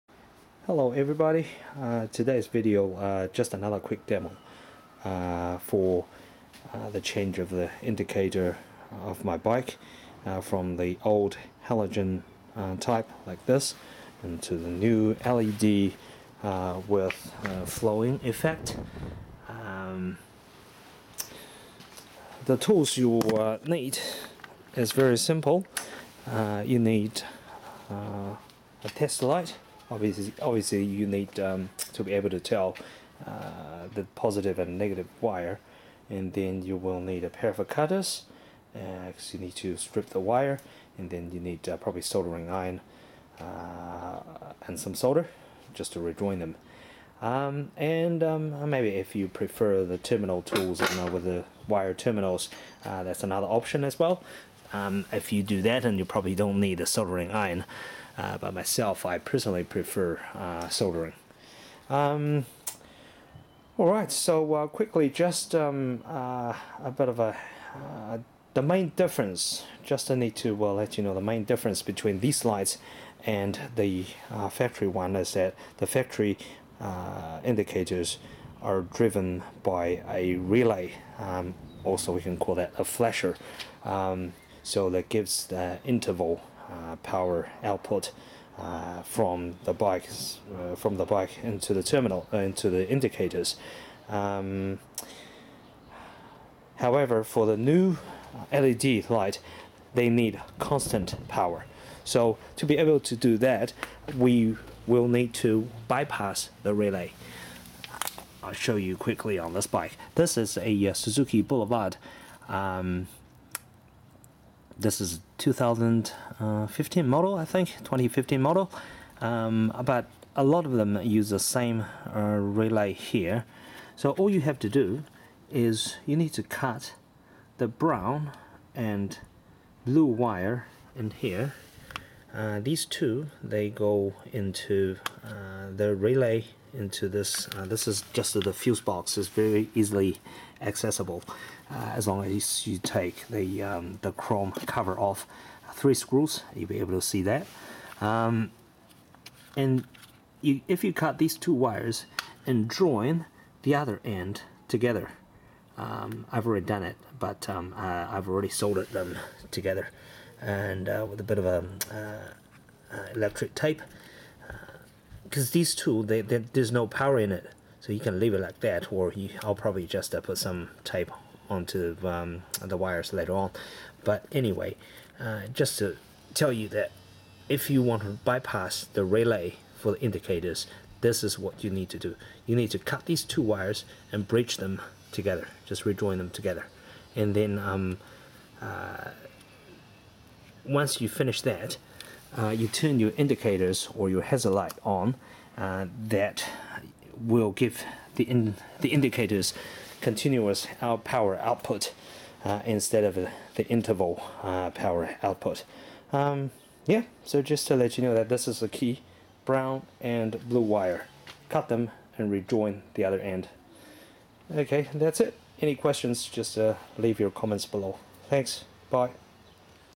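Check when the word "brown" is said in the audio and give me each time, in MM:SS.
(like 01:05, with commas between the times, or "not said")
02:07, 03:29.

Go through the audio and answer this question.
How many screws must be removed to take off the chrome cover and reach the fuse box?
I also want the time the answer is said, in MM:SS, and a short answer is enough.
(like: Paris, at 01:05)
3, at 02:25.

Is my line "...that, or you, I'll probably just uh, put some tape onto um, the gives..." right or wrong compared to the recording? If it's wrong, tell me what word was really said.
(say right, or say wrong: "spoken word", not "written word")
wrong: "wires", not "gives".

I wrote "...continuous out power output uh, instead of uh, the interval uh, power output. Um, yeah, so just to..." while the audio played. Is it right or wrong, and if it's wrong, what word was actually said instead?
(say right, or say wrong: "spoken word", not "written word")
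right.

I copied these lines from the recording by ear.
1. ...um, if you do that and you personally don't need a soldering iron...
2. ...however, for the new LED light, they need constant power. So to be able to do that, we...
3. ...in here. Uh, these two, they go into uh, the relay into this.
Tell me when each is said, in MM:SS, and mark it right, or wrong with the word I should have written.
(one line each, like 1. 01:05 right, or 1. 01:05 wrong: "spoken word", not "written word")
1. 00:54 wrong: "probably", not "personally"
2. 01:36 right
3. 02:10 right.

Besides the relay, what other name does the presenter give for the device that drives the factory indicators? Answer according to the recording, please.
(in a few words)
flasher.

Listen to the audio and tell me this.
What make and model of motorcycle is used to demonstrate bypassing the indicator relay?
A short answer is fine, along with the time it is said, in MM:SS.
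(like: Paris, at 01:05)
Suzuki Boulevard, at 01:50.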